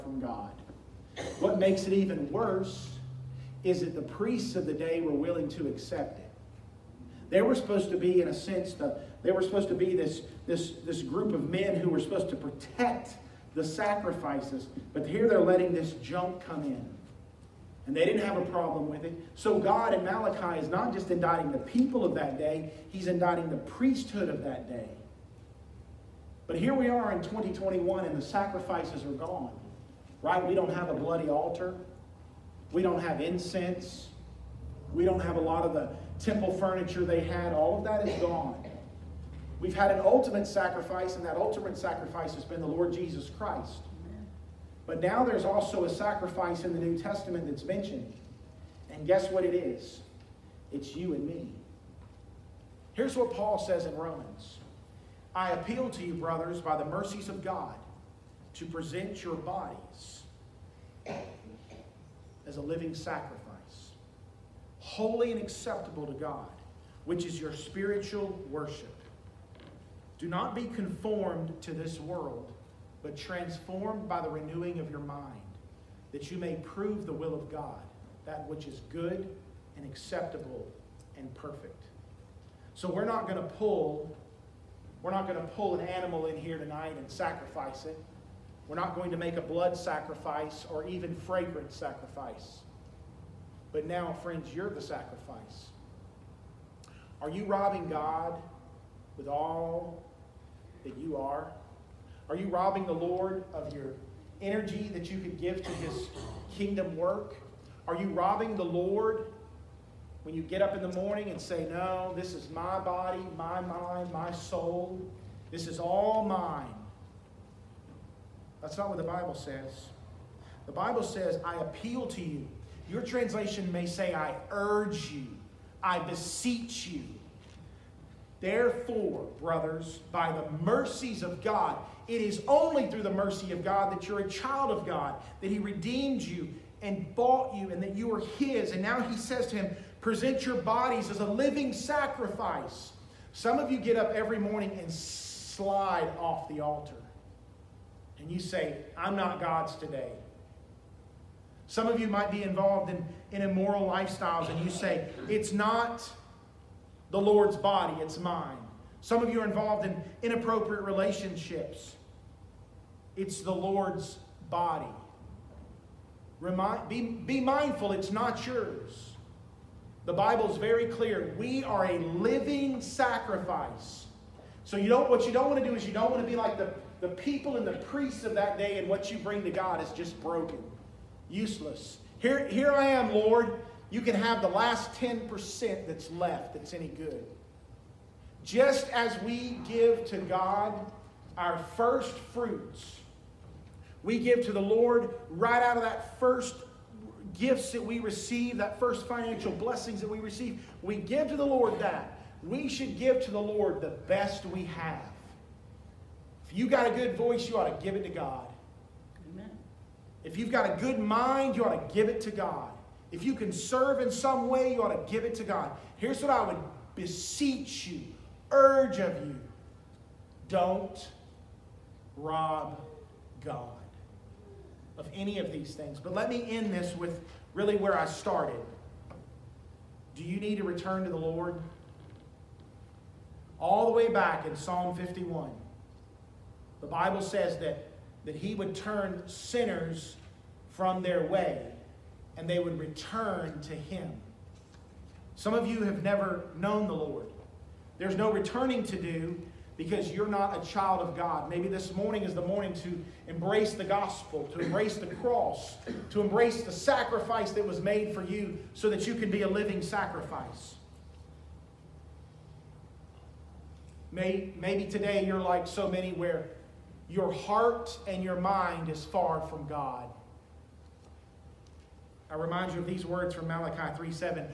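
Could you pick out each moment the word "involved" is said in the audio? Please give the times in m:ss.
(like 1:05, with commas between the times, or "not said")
2:32, 2:39.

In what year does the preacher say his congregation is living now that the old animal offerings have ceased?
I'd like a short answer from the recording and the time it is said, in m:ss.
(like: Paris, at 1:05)
2021, at 0:27.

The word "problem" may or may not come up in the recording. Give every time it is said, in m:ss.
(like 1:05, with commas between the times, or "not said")
0:18.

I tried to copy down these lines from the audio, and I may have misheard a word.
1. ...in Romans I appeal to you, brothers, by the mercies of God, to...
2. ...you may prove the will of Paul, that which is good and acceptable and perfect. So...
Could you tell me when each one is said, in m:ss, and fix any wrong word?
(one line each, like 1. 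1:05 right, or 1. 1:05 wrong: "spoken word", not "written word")
1. 0:53 right
2. 1:16 wrong: "God", not "Paul".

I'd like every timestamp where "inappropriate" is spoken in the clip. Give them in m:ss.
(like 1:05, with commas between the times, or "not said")
2:40.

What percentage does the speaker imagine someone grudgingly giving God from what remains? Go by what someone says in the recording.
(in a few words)
10%.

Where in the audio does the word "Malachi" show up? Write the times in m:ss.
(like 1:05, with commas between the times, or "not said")
0:20, 4:33.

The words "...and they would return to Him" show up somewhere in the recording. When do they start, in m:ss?
4:02.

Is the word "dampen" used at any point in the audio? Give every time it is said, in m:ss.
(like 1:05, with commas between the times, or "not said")
not said.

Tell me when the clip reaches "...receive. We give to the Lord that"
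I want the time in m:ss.
3:20.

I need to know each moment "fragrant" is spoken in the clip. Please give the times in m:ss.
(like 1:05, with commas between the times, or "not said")
1:31.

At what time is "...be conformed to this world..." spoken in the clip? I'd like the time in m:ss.
1:10.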